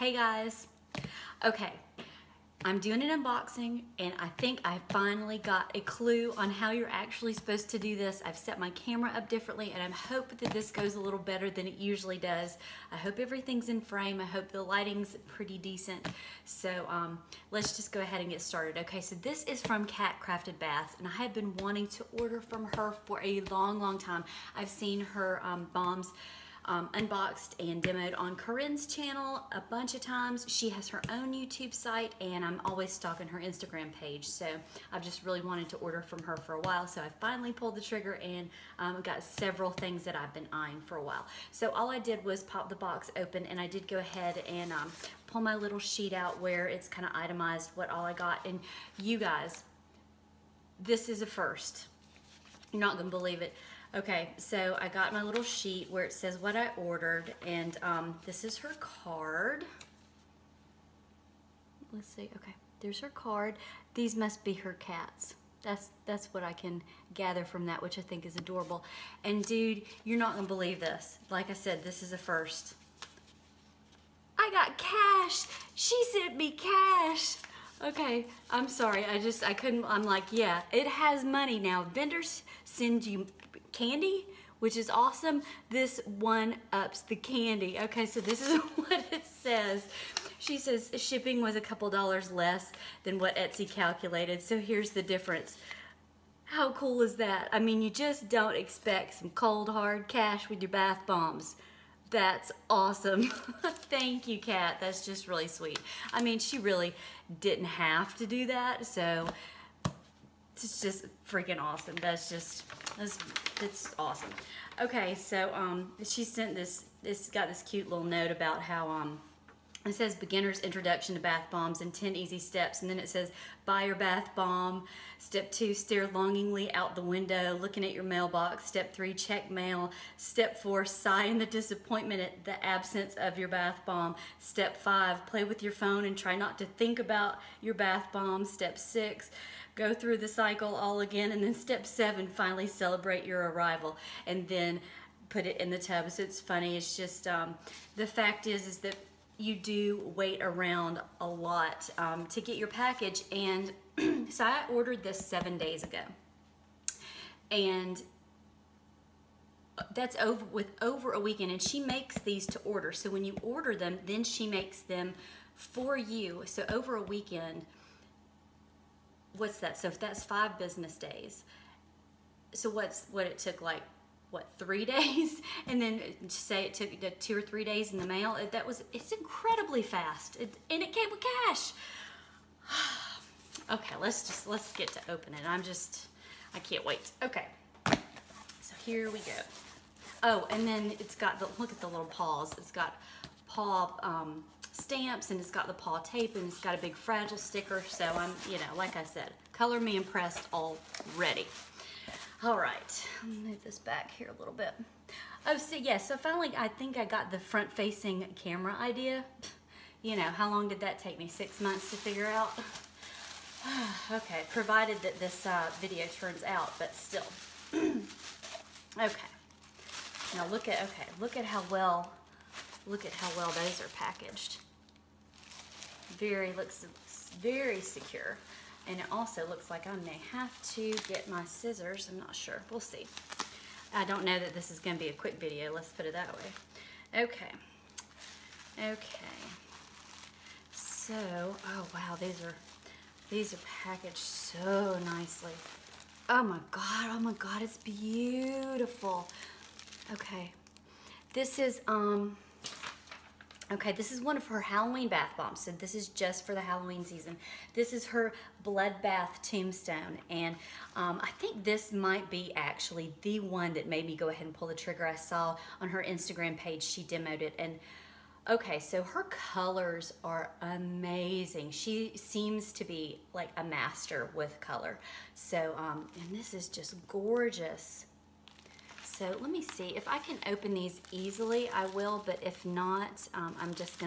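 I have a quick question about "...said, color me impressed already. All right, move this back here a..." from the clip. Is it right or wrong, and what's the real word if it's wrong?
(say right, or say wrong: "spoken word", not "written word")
right.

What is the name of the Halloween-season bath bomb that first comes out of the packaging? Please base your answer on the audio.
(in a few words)
Bloodbath Tombstone.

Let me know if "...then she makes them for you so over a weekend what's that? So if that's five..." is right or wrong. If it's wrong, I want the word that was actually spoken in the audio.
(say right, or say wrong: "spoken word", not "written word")
right.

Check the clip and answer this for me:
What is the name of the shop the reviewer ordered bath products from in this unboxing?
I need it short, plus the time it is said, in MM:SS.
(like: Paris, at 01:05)
Cat Crafted Baths, at 00:19.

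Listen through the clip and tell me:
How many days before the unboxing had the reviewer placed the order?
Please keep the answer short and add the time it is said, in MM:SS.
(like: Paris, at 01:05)
7, at 02:35.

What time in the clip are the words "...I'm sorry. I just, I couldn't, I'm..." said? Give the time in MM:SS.
01:18.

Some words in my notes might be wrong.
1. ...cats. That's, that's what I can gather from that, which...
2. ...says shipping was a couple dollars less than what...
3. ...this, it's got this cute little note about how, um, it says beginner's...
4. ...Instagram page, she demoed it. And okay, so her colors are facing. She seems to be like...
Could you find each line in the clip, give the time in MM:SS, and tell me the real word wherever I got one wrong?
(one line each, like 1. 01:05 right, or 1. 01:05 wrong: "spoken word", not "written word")
1. 01:04 right
2. 01:30 right
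3. 01:56 right
4. 04:26 wrong: "amazing", not "facing".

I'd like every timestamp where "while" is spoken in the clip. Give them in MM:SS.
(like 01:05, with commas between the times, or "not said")
00:36, 00:41.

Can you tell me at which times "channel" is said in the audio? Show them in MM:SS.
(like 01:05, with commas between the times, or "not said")
00:28.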